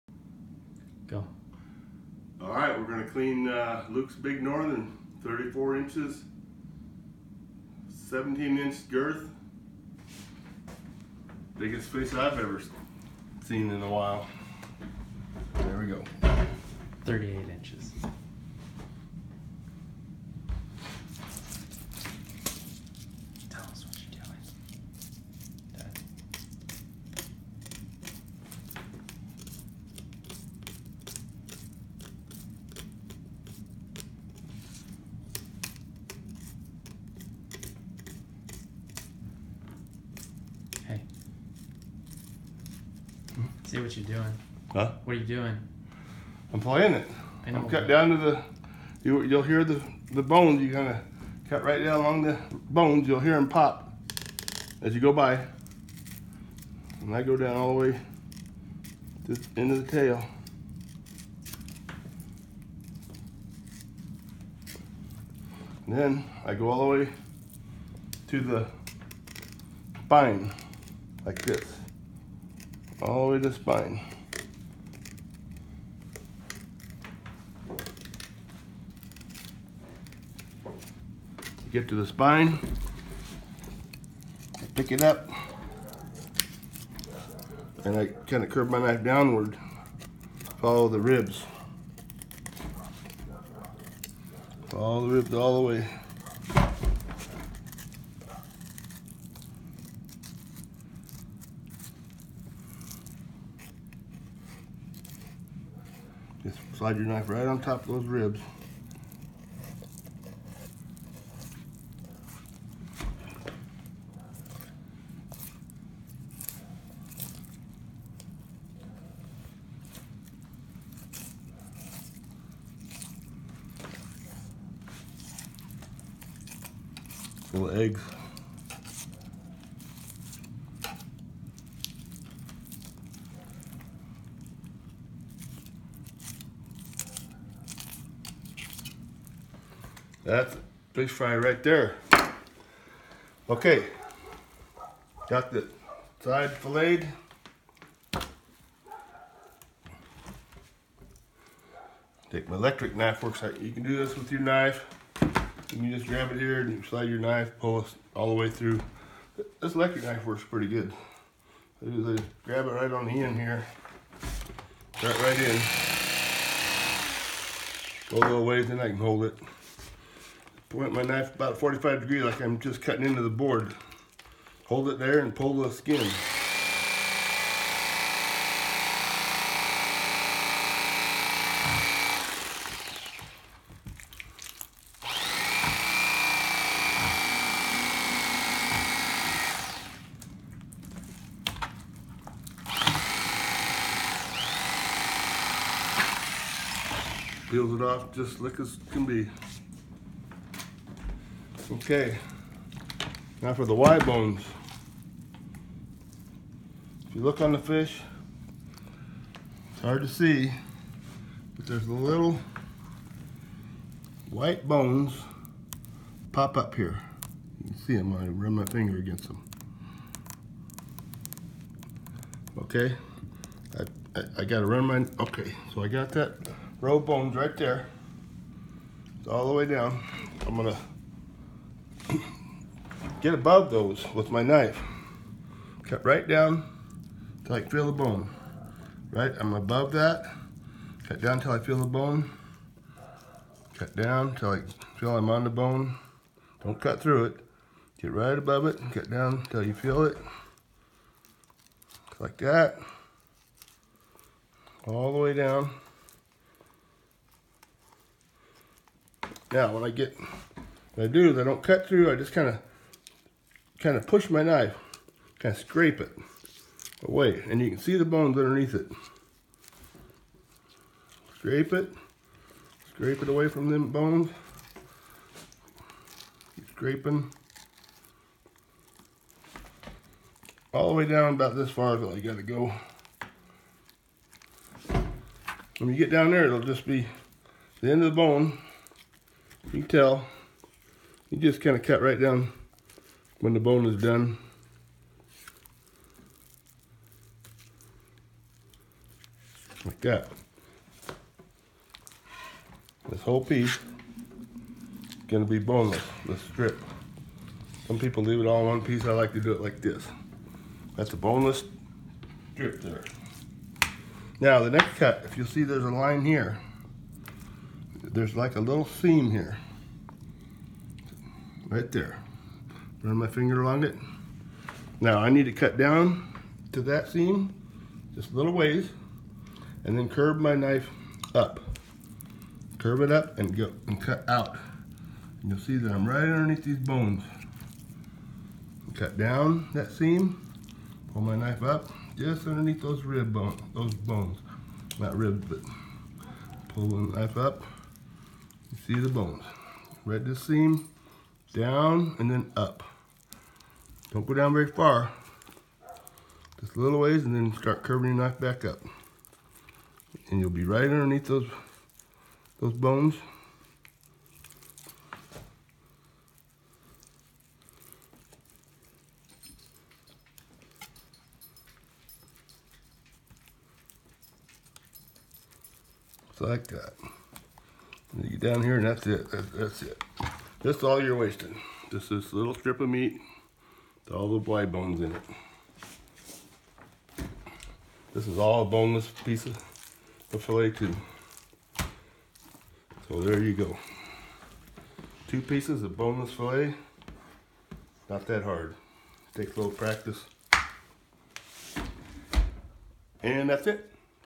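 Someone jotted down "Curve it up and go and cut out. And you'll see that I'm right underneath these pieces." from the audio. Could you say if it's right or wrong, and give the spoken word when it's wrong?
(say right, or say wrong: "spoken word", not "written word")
wrong: "bones", not "pieces".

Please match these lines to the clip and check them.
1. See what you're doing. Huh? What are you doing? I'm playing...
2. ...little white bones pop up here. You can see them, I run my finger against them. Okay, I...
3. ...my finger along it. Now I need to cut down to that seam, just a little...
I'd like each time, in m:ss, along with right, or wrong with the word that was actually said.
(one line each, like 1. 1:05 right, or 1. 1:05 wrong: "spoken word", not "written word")
1. 0:43 right
2. 3:31 right
3. 5:23 right.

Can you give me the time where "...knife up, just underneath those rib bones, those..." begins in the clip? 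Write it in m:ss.
5:41.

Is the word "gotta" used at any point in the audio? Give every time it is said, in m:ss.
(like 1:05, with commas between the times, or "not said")
3:44, 4:42.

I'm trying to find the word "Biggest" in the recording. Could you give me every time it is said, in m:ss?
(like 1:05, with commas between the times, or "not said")
0:11.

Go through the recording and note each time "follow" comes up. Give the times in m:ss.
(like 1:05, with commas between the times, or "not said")
1:30, 1:34.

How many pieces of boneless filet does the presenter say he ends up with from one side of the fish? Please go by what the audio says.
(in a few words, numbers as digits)
2.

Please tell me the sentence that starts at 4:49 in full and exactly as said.
You can tell you just kind of cut right down when the bone is done.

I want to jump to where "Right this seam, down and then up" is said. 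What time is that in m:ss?
5:50.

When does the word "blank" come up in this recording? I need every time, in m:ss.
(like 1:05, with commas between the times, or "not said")
not said.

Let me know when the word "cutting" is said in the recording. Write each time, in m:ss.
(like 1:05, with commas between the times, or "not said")
2:52.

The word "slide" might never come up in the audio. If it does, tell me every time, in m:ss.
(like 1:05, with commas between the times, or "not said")
1:46, 2:36.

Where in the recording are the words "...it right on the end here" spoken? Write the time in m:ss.
2:42.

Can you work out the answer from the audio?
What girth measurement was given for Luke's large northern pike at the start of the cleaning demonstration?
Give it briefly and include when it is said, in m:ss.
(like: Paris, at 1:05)
17 inch, at 0:08.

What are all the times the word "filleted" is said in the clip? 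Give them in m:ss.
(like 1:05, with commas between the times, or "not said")
2:26.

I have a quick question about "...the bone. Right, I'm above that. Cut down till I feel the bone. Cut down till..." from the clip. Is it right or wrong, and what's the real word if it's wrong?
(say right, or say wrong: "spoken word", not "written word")
right.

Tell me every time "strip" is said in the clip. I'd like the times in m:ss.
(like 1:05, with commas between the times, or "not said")
5:06, 5:12, 6:22.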